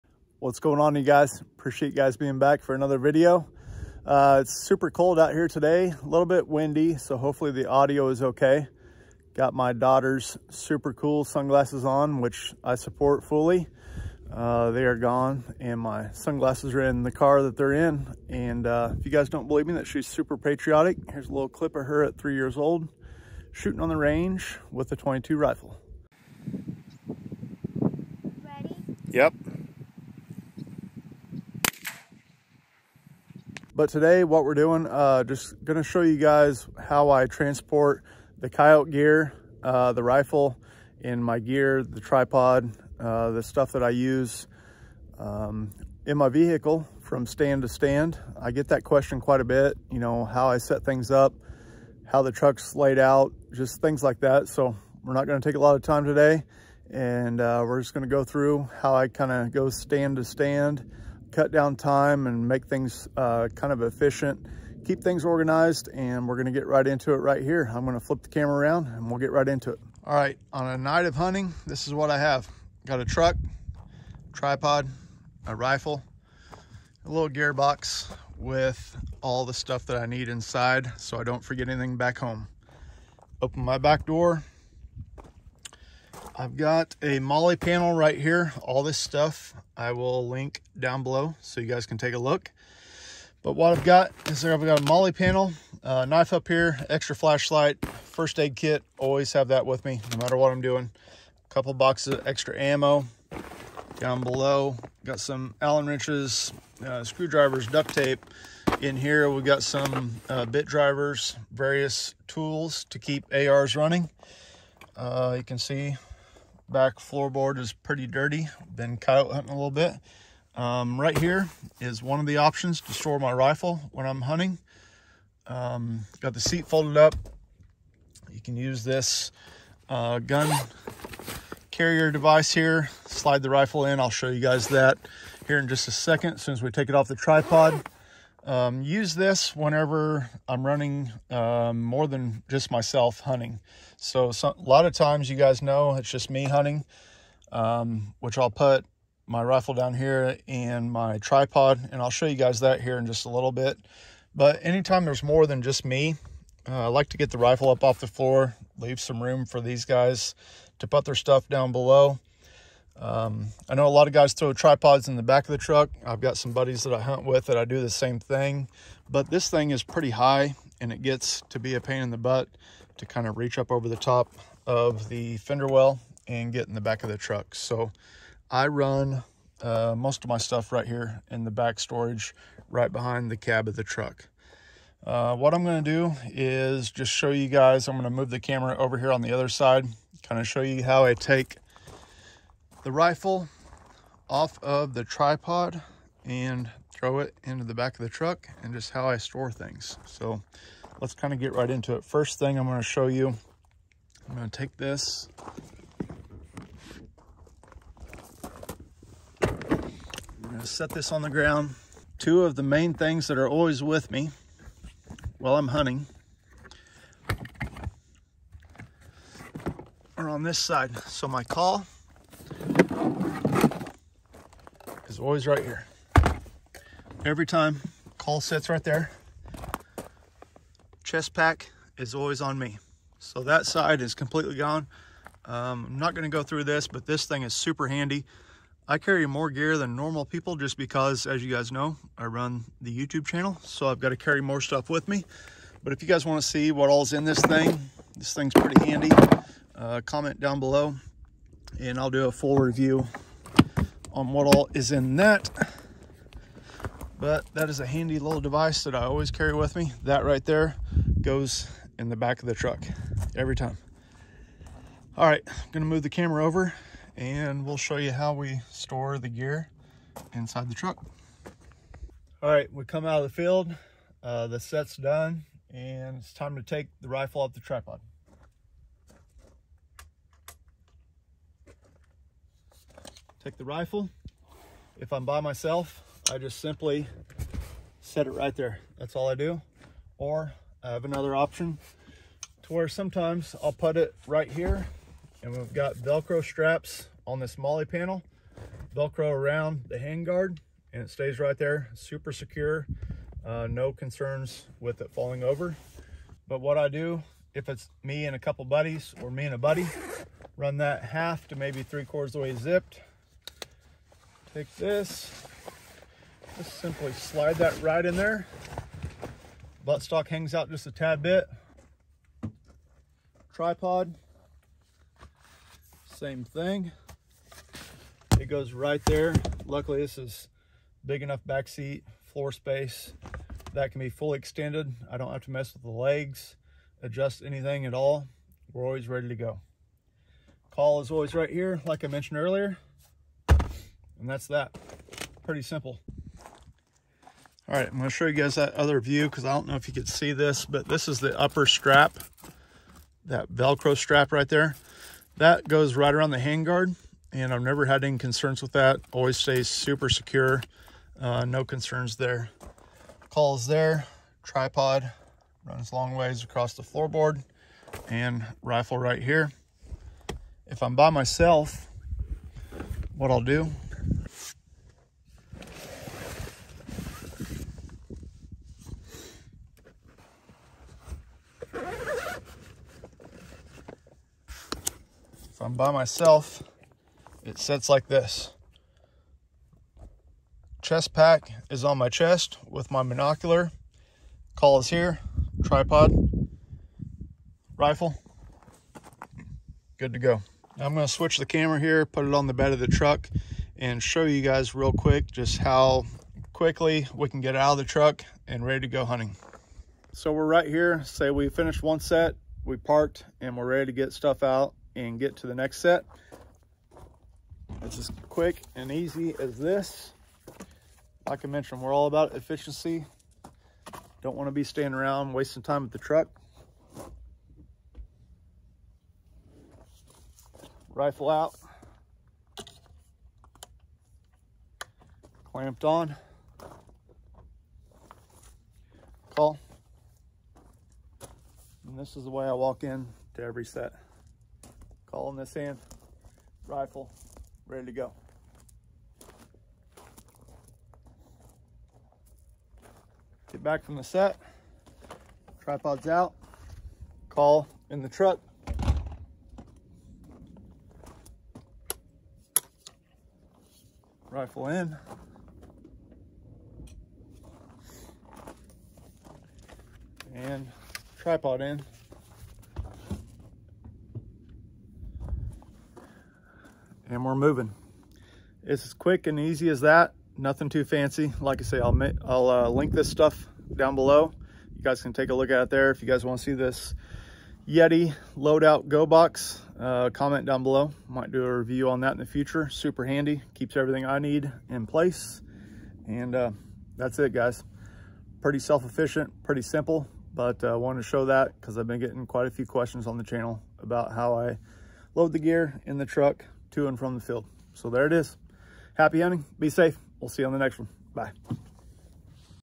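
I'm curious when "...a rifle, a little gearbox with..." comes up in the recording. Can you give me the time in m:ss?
1:15.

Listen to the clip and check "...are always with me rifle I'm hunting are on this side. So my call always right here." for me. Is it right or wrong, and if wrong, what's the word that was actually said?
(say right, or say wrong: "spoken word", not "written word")
wrong: "while", not "rifle".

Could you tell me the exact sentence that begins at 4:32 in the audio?
All right, we come out of the field, uh, the set's done, and it's time to take the rifle off the tripod.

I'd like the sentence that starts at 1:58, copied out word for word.
Been coyote hunting a little bit.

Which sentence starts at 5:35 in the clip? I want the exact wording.
I don't have to mess with the legs, adjust anything at all.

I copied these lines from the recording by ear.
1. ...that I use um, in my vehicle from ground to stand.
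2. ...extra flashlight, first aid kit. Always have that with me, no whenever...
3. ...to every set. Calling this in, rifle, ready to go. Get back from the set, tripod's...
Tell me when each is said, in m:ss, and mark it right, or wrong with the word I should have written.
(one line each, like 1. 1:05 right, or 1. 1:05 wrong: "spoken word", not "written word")
1. 0:43 wrong: "stand", not "ground"
2. 1:36 wrong: "matter", not "whenever"
3. 7:23 right.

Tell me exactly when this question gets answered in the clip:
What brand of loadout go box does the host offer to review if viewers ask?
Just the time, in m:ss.
8:07.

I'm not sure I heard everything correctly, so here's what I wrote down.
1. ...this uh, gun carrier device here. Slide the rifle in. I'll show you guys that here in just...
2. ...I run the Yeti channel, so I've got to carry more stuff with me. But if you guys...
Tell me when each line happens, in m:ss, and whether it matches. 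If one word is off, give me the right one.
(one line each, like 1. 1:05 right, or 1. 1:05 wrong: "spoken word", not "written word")
1. 2:08 right
2. 4:02 wrong: "YouTube", not "Yeti".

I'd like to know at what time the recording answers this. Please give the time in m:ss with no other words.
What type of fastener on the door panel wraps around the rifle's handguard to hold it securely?
4:55.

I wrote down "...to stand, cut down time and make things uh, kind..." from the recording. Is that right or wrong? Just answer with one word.
right.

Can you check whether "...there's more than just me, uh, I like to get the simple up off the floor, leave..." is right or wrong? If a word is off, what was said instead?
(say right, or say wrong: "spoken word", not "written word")
wrong: "rifle", not "simple".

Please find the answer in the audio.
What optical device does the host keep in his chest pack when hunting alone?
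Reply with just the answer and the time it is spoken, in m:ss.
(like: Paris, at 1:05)
Monocular, at 6:33.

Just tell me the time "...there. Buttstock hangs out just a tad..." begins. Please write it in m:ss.
5:18.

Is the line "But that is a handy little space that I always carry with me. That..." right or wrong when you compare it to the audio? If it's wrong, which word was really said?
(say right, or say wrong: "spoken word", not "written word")
wrong: "device", not "space".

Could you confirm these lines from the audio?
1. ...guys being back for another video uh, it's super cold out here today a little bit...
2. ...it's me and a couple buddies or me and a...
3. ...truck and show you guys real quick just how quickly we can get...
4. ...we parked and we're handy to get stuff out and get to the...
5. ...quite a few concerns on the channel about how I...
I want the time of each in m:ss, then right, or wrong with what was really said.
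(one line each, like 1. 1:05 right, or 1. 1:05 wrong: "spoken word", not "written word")
1. 0:01 right
2. 5:07 right
3. 6:42 right
4. 6:52 wrong: "ready", not "handy"
5. 8:22 wrong: "questions", not "concerns".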